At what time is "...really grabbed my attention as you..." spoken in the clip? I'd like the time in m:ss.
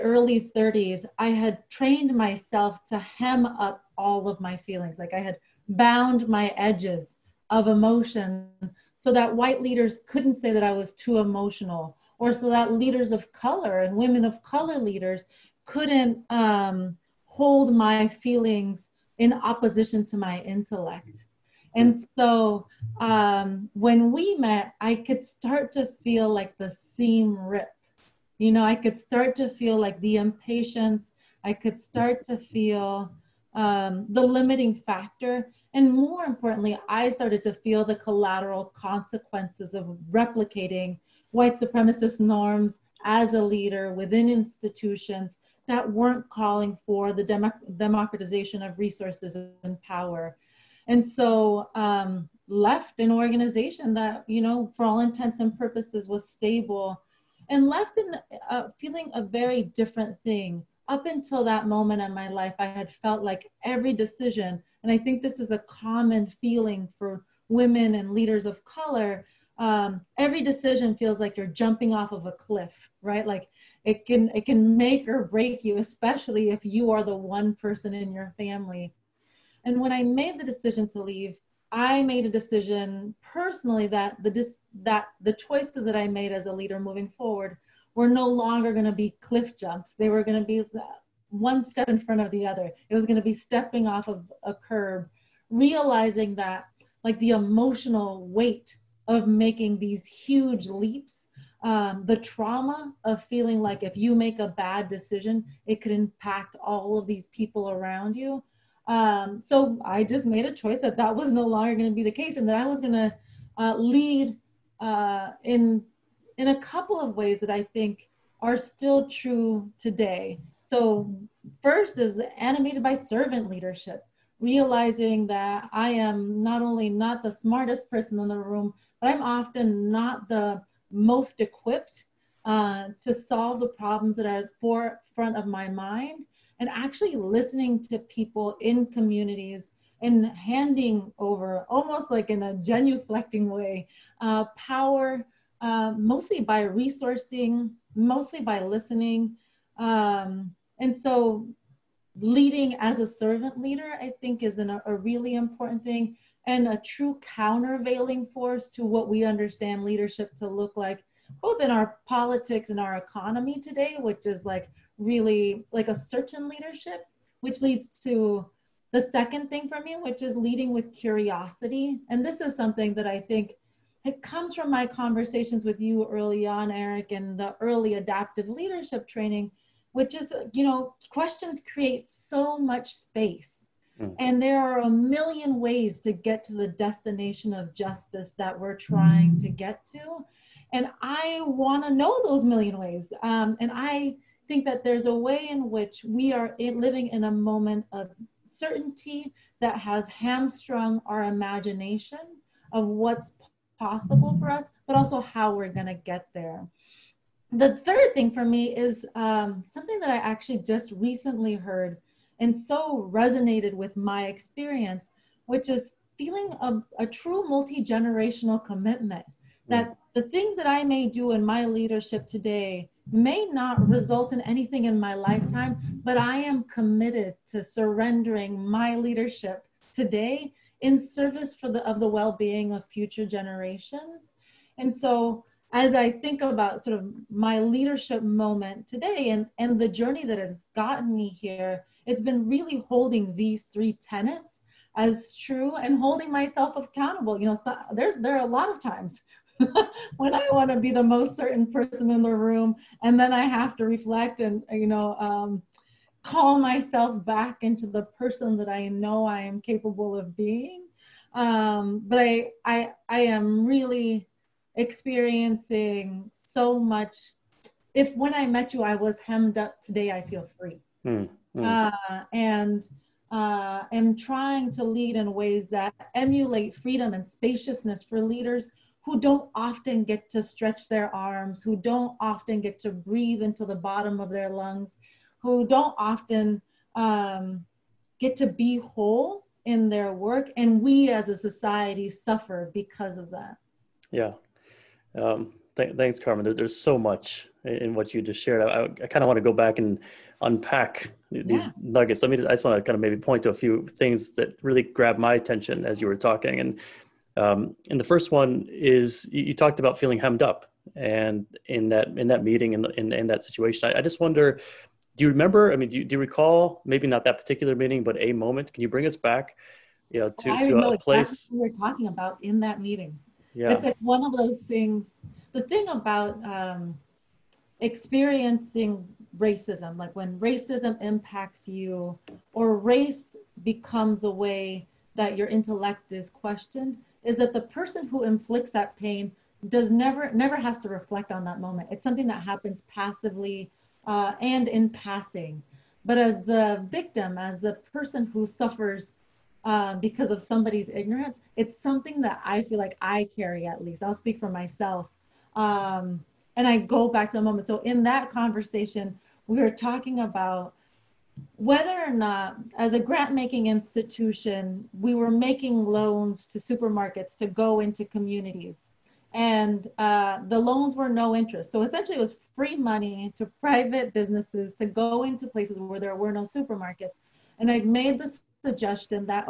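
5:04.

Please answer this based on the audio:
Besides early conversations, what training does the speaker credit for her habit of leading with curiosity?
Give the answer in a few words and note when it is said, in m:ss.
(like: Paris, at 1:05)
adaptive leadership, at 2:57.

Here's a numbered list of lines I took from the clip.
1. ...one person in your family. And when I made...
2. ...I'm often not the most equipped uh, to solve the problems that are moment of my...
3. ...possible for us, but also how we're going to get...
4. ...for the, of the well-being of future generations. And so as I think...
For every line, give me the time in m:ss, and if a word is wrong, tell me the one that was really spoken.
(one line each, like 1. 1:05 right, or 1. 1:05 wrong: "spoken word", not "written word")
1. 1:17 right
2. 2:09 wrong: "forefront", not "moment"
3. 3:23 right
4. 3:51 right.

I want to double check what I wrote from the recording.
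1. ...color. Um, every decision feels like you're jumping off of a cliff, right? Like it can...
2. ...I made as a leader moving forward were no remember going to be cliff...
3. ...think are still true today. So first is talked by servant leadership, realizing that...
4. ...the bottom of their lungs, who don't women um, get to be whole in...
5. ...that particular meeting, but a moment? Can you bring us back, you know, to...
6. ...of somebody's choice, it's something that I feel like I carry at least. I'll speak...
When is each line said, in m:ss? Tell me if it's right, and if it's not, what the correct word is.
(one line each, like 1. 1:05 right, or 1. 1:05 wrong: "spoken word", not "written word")
1. 1:08 right
2. 1:25 wrong: "longer", not "remember"
3. 1:57 wrong: "animated", not "talked"
4. 4:43 wrong: "often", not "women"
5. 5:17 right
6. 5:50 wrong: "ignorance", not "choice".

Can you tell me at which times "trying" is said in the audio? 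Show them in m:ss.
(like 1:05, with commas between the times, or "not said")
3:08, 4:34.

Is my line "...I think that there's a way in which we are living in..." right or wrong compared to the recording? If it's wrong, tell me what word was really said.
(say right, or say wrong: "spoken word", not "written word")
right.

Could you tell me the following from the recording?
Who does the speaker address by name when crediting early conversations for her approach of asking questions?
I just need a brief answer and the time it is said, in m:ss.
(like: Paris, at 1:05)
Eric, at 2:56.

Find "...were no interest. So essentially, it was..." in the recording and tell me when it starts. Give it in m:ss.
6:10.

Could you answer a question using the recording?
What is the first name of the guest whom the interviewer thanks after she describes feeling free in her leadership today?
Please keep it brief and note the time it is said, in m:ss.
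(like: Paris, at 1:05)
Carmen, at 4:56.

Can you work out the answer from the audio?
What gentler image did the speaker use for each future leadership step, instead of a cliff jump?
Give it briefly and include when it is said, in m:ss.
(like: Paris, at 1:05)
stepping off of a curb, at 1:33.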